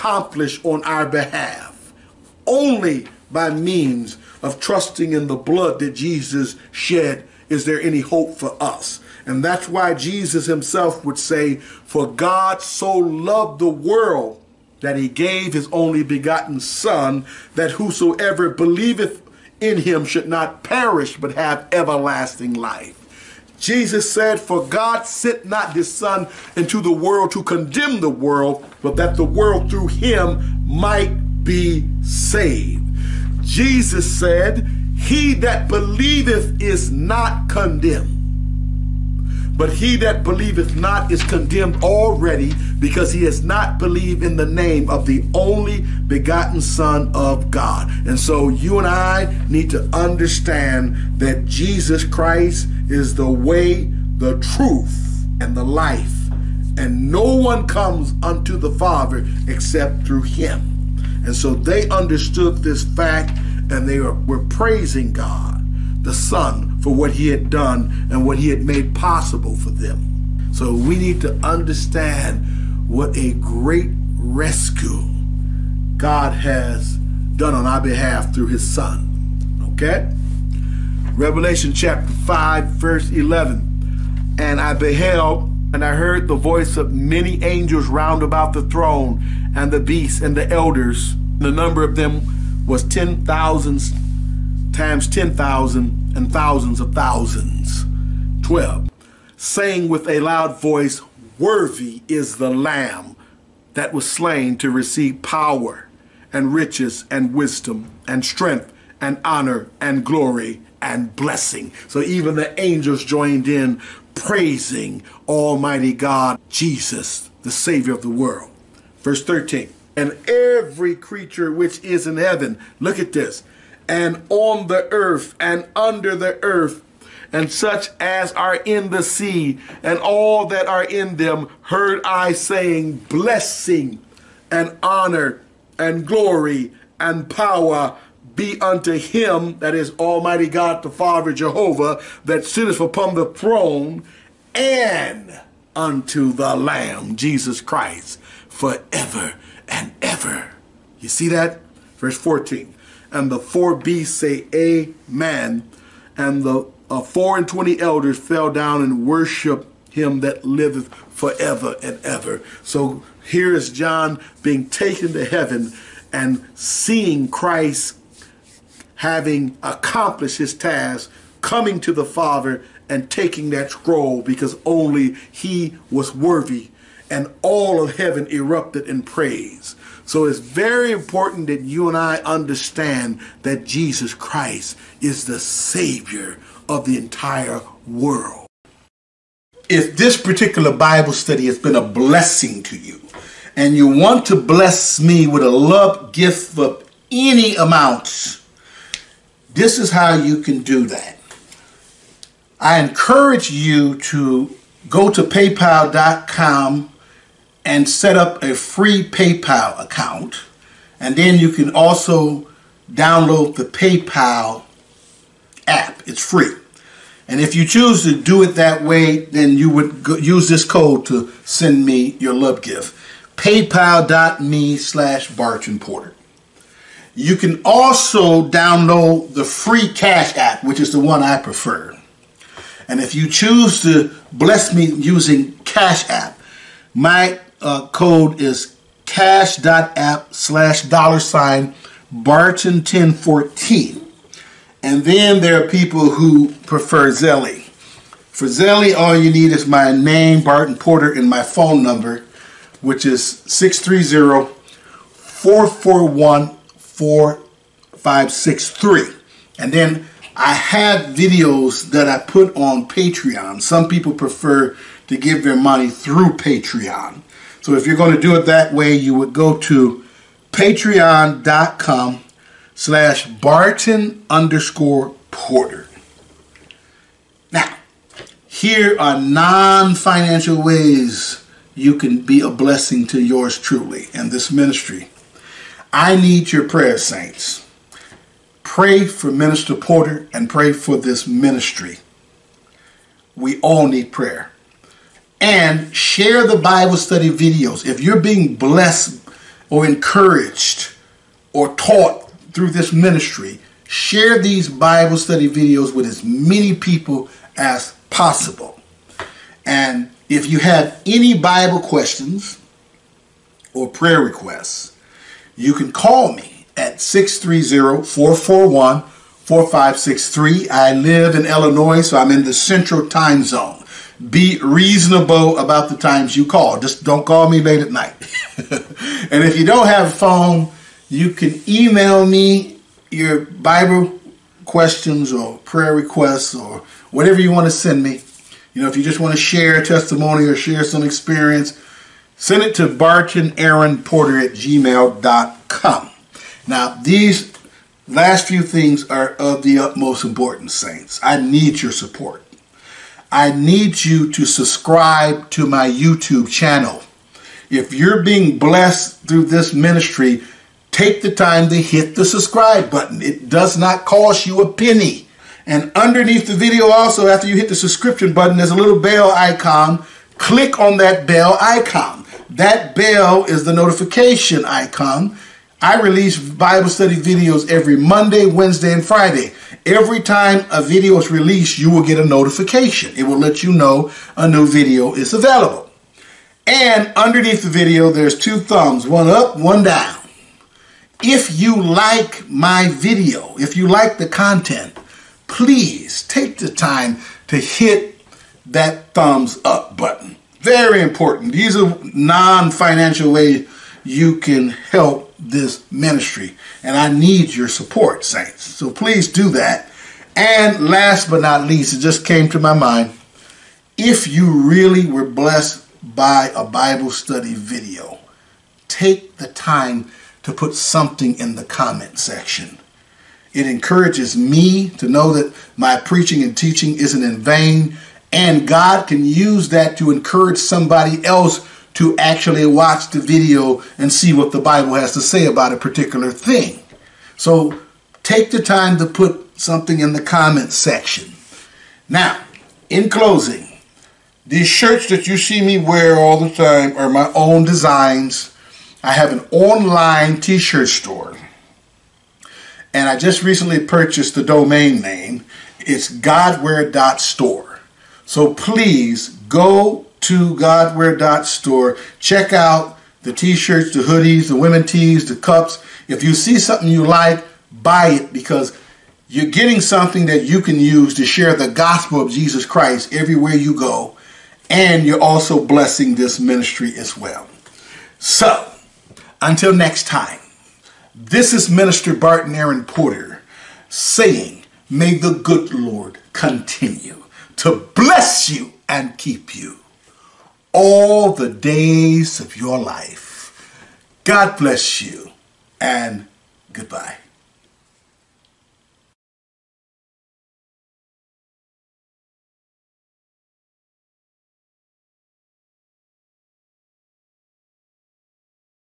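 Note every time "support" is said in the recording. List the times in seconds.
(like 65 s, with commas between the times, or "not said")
351 s, 407 s.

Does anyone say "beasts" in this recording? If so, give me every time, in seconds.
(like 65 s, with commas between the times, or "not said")
89 s, 153 s.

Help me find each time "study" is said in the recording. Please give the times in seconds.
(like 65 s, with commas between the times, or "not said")
191 s, 296 s, 305 s, 376 s, 417 s.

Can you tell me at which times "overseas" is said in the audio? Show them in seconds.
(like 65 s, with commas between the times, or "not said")
not said.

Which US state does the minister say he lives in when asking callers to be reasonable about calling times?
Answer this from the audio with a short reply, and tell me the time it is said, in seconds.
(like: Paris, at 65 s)
Illinois, at 321 s.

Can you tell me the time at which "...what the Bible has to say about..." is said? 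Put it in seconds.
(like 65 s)
434 s.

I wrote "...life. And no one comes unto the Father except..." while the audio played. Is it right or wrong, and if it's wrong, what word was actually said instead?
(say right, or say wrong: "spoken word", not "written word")
right.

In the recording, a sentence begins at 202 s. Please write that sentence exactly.
I encourage you to go to paypal.com and set up a free PayPal account.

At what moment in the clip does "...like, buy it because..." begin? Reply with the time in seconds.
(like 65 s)
467 s.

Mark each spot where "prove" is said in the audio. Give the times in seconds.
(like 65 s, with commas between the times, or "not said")
not said.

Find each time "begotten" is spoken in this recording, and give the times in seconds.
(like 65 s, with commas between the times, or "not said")
16 s, 46 s.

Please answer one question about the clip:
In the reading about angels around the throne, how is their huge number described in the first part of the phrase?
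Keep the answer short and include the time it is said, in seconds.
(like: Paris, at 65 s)
ten thousands times ten thousand, at 92 s.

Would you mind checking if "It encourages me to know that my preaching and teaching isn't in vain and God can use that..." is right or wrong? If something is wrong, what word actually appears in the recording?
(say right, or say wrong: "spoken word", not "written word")
right.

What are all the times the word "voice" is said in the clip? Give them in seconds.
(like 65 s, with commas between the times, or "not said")
86 s, 100 s.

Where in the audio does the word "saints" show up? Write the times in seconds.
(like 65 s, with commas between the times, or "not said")
286 s, 350 s, 408 s.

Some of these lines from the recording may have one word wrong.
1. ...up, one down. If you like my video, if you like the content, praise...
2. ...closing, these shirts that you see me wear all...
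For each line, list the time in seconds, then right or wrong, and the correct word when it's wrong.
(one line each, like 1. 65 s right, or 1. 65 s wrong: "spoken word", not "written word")
1. 389 s wrong: "please", not "praise"
2. 443 s right.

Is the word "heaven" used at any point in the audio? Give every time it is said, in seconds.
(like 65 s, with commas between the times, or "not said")
122 s, 165 s, 177 s.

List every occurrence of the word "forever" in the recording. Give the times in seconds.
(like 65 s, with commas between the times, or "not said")
148 s, 160 s.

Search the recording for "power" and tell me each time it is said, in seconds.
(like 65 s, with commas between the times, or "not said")
105 s, 137 s.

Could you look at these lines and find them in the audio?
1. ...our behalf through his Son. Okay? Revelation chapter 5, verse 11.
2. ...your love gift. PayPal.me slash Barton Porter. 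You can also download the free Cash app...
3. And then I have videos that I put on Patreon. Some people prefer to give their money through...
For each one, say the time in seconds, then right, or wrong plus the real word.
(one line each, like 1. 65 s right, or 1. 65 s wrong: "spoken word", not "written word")
1. 77 s right
2. 222 s right
3. 259 s right.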